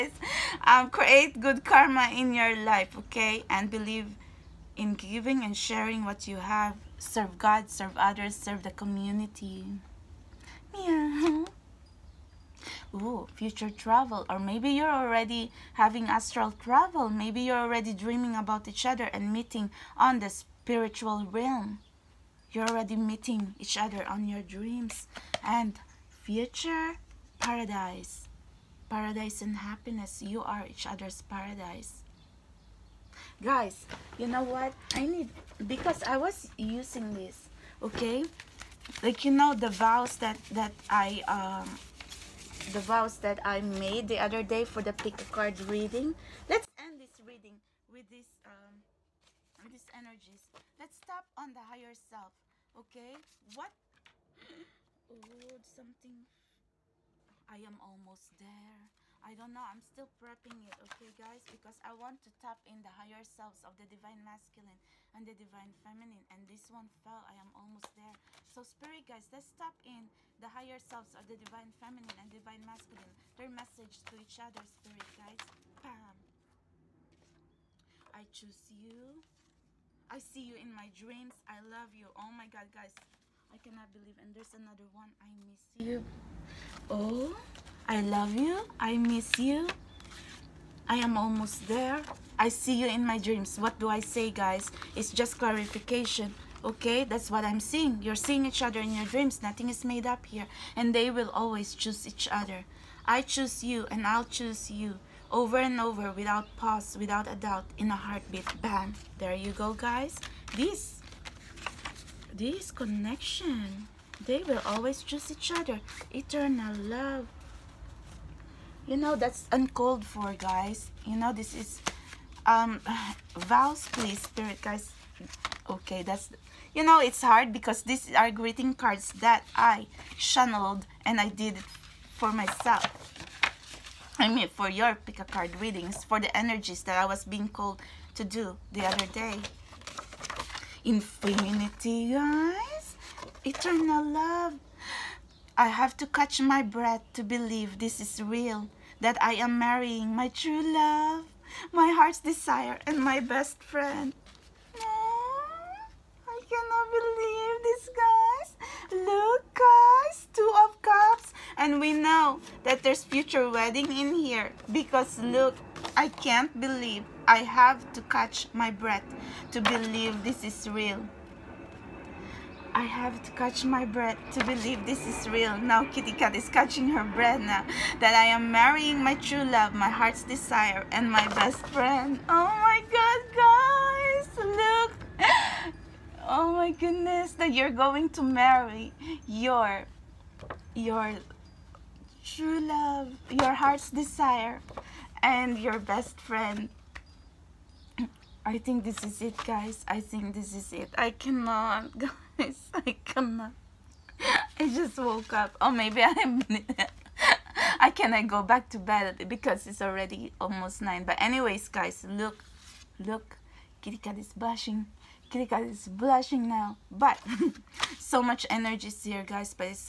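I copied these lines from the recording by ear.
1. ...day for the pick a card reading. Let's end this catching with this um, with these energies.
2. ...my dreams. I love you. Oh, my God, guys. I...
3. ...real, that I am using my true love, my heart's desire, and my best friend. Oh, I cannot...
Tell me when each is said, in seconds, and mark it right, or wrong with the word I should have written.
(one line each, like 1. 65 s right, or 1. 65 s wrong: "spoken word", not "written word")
1. 44 s wrong: "reading", not "catching"
2. 80 s right
3. 148 s wrong: "marrying", not "using".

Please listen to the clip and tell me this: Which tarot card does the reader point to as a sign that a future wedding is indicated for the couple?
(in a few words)
Two of Cups.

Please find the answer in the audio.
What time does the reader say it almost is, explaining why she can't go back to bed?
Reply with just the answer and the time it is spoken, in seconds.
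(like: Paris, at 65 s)
nine, at 210 s.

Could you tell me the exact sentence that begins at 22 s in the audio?
You're already meeting each other on your dreams and future paradise.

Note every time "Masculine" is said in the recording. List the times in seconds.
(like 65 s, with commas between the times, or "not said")
64 s, 72 s.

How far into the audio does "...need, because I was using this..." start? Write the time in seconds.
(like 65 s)
35 s.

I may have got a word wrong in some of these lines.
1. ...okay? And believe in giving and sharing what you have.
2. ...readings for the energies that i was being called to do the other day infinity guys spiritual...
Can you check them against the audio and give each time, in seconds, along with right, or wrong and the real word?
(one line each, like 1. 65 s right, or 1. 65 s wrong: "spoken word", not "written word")
1. 3 s right
2. 135 s wrong: "eternal", not "spiritual".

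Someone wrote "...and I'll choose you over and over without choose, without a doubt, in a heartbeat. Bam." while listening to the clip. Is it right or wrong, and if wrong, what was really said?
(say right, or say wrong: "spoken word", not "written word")
wrong: "pause", not "choose".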